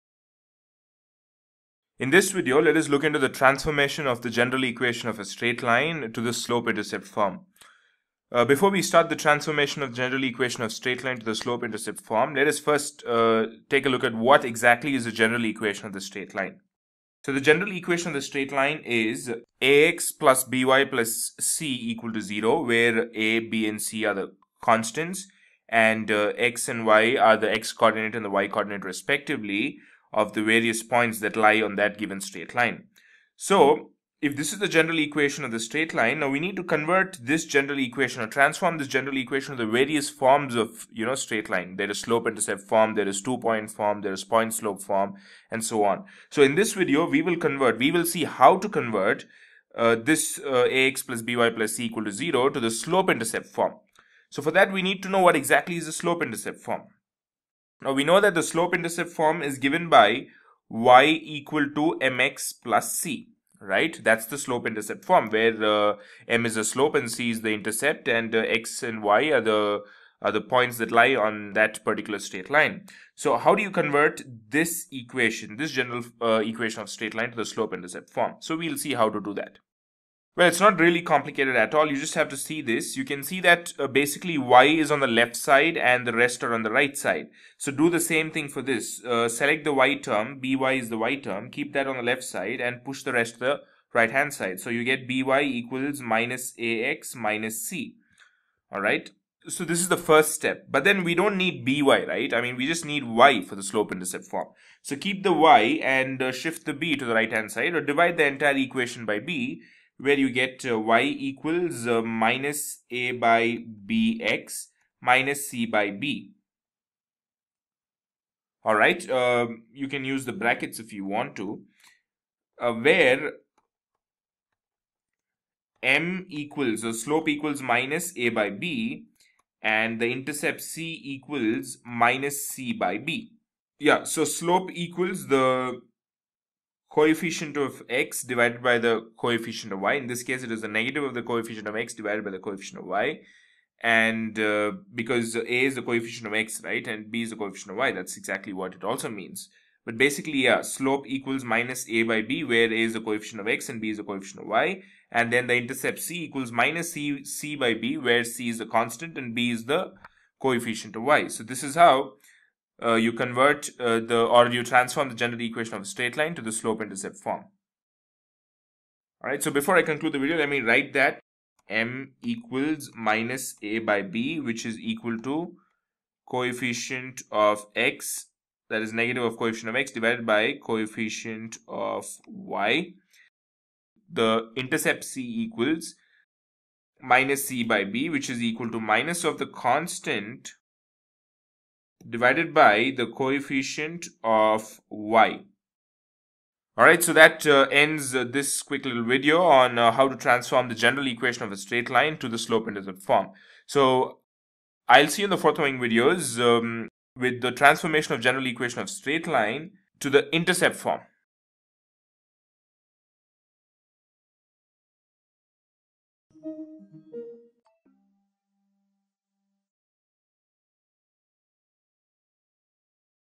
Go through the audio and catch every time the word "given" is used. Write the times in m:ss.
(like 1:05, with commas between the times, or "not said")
0:31, 0:59.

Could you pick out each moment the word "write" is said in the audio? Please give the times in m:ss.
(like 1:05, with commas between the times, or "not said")
2:50.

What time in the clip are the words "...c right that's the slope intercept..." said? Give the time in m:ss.
1:02.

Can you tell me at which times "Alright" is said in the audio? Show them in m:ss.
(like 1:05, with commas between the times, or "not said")
1:38, 1:58, 2:49, 3:16.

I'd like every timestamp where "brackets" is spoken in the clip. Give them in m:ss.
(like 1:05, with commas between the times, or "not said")
2:00.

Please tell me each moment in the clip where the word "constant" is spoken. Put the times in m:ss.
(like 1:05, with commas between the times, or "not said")
0:24, 2:38, 3:09.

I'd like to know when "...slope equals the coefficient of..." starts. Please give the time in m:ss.
2:14.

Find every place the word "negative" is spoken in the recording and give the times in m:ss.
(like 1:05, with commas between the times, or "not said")
2:20, 2:58.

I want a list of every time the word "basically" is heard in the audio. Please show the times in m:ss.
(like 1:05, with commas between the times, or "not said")
1:23, 2:29.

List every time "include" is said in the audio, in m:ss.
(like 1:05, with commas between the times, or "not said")
not said.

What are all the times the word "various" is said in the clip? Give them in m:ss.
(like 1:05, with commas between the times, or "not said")
0:30, 0:39.